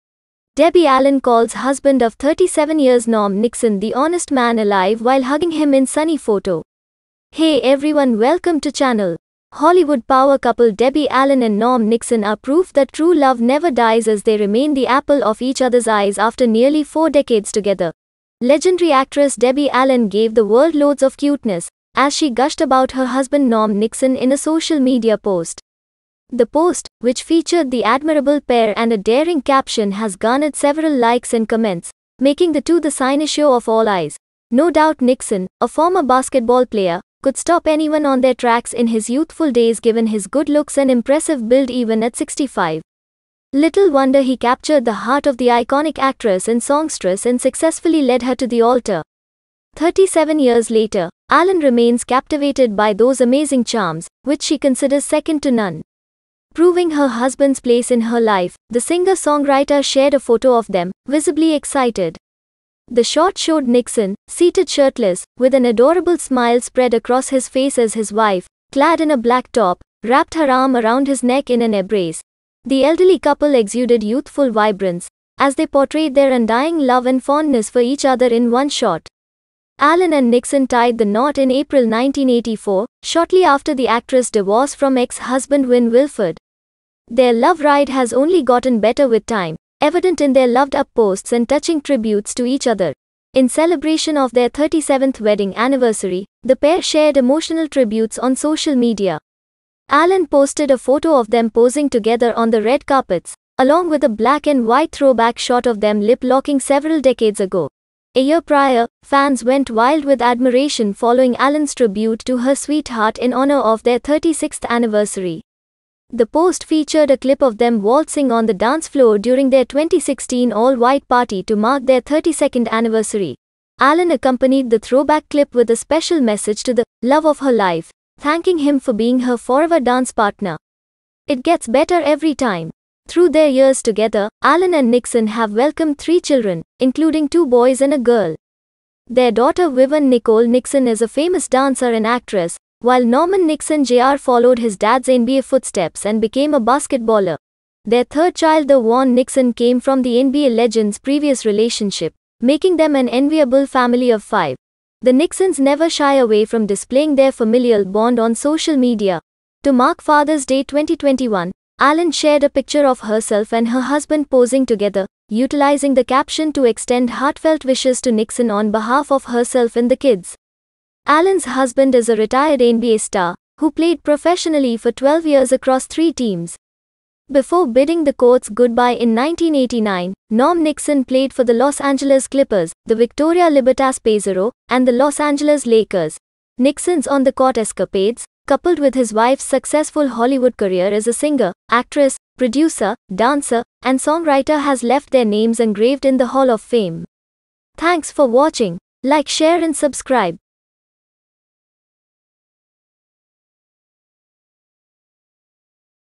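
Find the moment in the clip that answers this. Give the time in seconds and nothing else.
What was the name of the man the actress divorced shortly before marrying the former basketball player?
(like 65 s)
85 s.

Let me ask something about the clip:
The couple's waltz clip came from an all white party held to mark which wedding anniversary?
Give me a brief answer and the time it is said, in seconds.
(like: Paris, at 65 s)
32nd, at 122 s.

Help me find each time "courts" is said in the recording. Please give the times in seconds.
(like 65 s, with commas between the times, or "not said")
178 s, 187 s.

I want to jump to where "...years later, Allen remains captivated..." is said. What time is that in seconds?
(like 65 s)
50 s.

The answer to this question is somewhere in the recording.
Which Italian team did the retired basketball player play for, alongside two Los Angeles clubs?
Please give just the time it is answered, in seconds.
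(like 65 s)
182 s.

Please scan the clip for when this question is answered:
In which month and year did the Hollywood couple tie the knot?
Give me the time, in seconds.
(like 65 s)
81 s.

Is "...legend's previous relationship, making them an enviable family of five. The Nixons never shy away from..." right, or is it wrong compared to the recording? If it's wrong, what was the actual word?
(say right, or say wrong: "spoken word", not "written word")
right.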